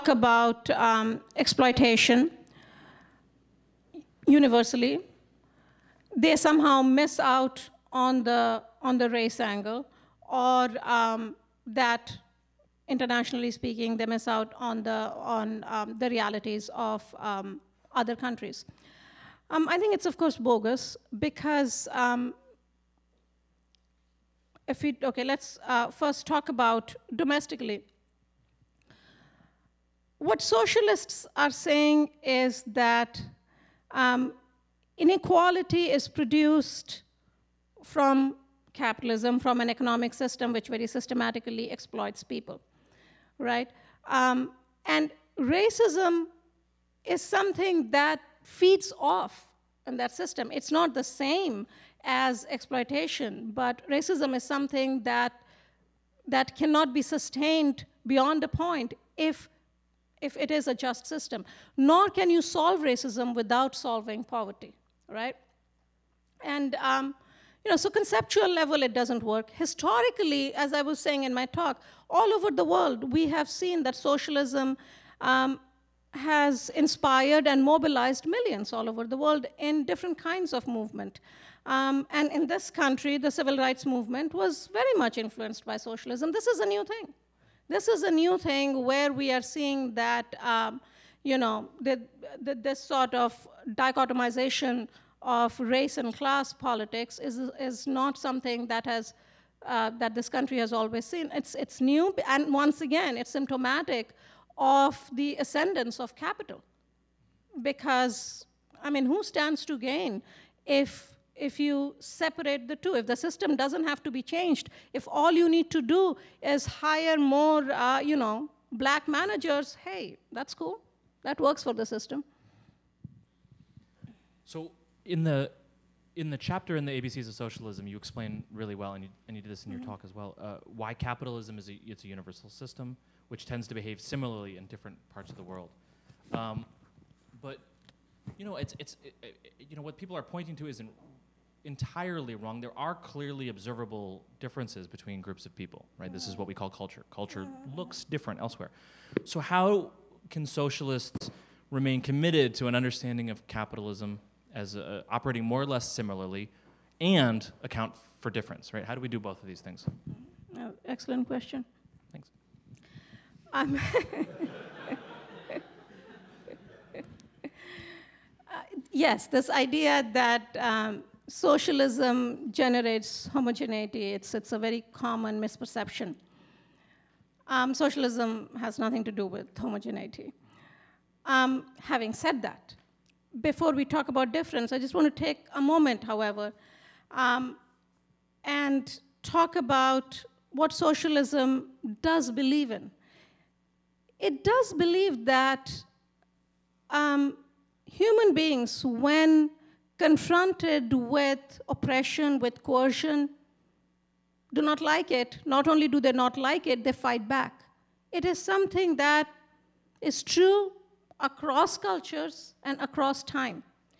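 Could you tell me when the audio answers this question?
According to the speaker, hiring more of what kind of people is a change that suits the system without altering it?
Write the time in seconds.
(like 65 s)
118 s.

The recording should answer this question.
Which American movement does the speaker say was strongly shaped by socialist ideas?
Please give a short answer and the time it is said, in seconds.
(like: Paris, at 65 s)
civil rights movement, at 83 s.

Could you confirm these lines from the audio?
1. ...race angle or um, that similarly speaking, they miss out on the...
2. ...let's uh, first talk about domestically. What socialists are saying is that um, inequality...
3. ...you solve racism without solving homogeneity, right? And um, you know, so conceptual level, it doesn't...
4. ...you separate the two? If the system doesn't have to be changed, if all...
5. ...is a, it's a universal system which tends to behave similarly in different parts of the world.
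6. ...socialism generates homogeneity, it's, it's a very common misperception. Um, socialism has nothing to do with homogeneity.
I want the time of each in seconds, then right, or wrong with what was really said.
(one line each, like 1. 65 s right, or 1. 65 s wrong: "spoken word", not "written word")
1. 9 s wrong: "internationally", not "similarly"
2. 25 s right
3. 62 s wrong: "poverty", not "homogeneity"
4. 111 s right
5. 131 s right
6. 171 s right.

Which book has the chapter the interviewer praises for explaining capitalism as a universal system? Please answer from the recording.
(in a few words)
ABCs of Socialism.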